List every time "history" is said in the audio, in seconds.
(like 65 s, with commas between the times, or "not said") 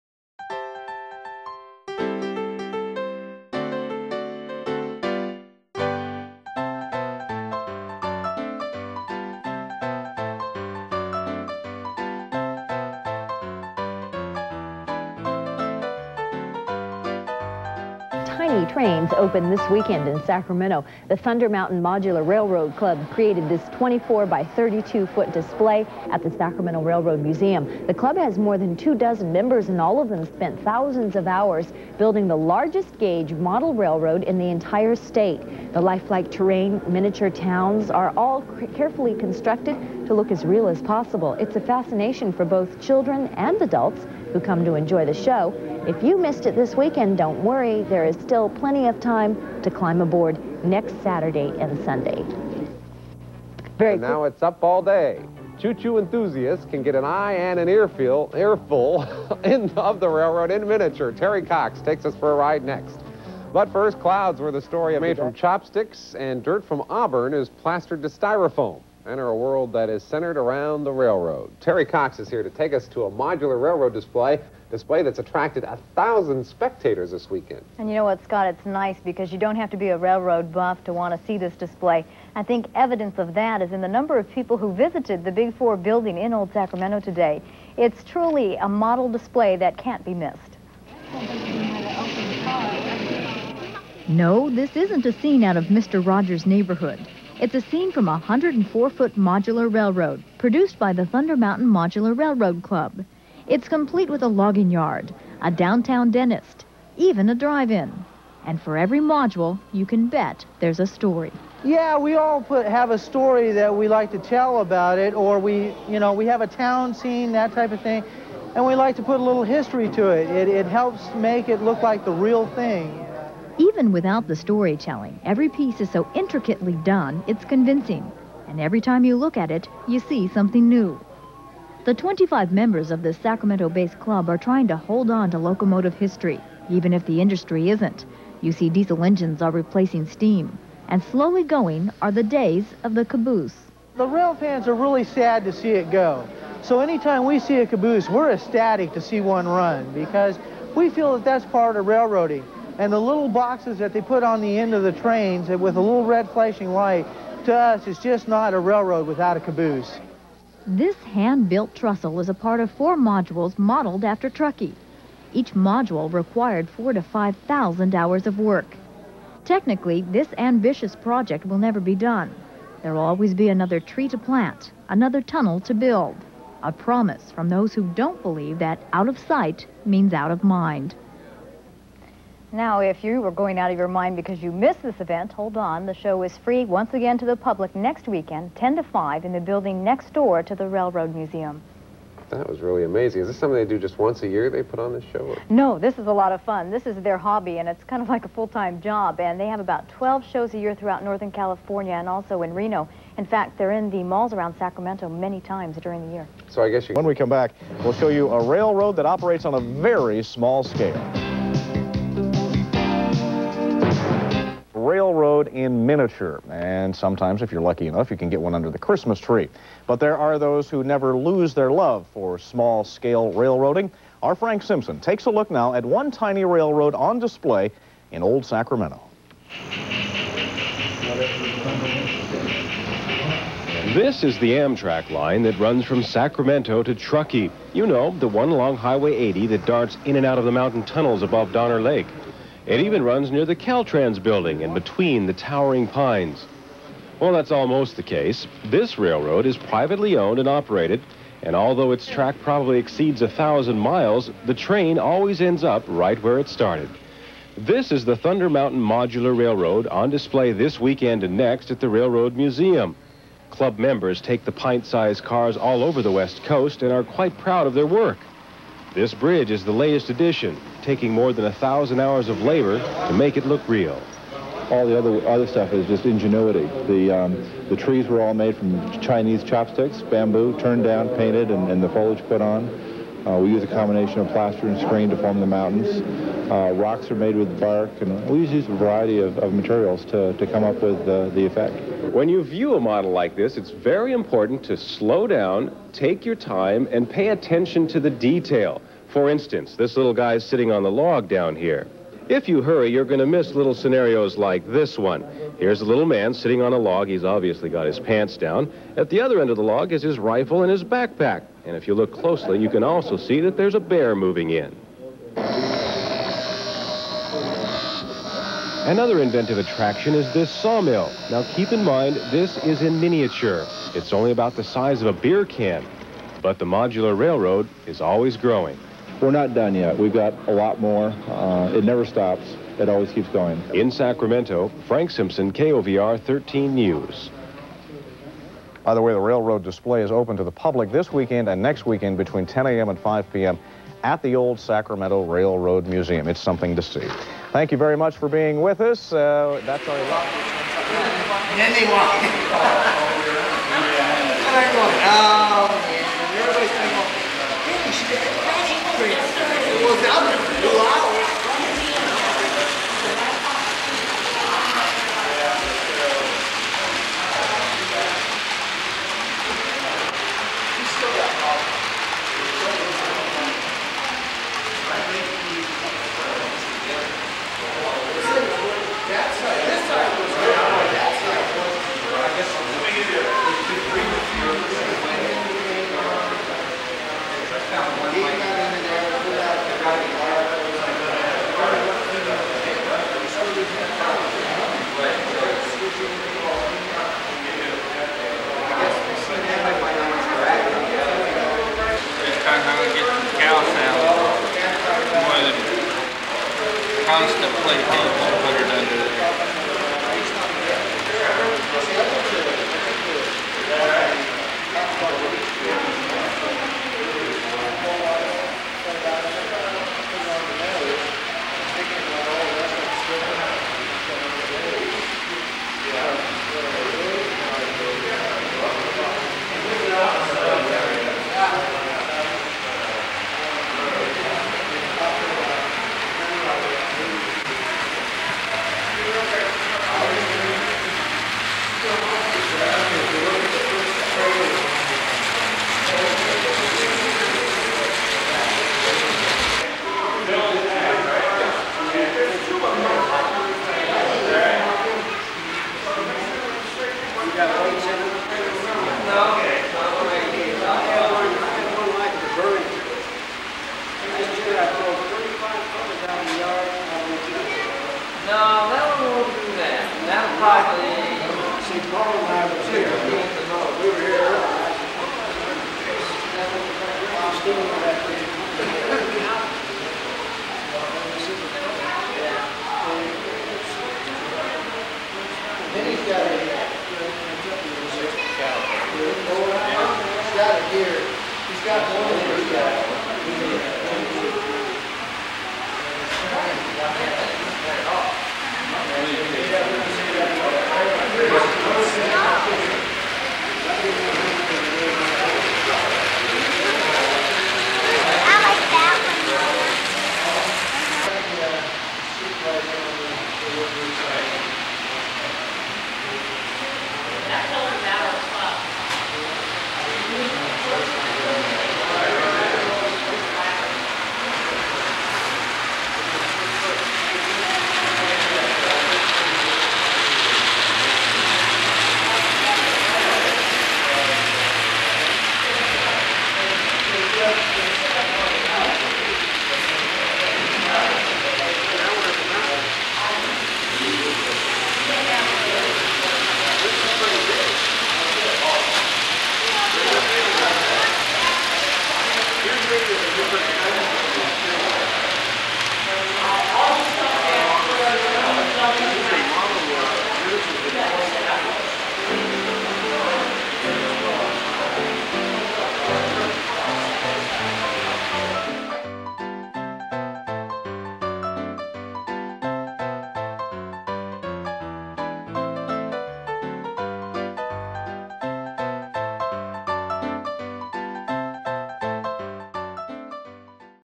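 119 s, 135 s.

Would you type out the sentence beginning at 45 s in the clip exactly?
If you missed it this weekend, don't worry.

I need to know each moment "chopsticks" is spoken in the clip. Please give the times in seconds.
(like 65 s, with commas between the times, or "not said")
65 s, 279 s.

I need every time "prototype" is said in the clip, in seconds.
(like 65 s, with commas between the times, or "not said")
not said.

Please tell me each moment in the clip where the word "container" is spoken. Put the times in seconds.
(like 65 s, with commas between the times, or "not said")
not said.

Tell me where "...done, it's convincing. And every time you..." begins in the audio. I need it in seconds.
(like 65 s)
126 s.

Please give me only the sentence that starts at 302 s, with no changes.
If you hurry, you're going to miss little scenarios like this one.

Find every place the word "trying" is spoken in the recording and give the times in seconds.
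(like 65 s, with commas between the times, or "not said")
134 s.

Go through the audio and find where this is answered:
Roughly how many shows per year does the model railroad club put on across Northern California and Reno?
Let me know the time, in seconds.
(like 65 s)
199 s.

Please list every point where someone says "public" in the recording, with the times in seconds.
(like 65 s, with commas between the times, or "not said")
187 s, 340 s.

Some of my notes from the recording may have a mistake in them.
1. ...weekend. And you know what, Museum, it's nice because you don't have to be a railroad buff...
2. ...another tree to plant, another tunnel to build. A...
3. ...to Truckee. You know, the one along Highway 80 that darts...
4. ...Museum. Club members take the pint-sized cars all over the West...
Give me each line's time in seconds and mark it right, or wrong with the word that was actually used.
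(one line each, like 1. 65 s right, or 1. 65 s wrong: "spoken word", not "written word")
1. 77 s wrong: "Scott", not "Museum"
2. 173 s right
3. 236 s right
4. 262 s right.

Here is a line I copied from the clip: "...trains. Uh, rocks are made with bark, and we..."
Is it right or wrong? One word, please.
wrong.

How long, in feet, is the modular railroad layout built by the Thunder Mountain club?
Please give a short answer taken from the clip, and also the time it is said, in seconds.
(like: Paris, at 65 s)
104 feet, at 98 s.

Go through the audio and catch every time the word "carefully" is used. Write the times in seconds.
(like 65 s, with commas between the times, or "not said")
38 s.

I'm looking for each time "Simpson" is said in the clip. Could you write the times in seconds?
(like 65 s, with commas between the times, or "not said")
224 s, 335 s.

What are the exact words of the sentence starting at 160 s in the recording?
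This hand-built trestle is a part of four modules modeled after Truckee.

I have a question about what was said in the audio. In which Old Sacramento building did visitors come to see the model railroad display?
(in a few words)
Big Four building.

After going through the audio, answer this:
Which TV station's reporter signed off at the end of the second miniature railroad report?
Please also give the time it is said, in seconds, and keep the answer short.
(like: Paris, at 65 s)
KOVR 13 News, at 335 s.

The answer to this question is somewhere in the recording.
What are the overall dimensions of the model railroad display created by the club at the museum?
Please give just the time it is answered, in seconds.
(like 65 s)
23 s.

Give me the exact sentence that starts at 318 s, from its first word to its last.
Another inventive attraction is this sawmill.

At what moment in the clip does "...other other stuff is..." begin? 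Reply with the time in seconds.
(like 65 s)
274 s.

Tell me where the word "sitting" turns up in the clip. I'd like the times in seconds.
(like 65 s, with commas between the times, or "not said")
300 s, 306 s.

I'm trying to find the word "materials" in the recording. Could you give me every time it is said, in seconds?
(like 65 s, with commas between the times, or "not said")
289 s.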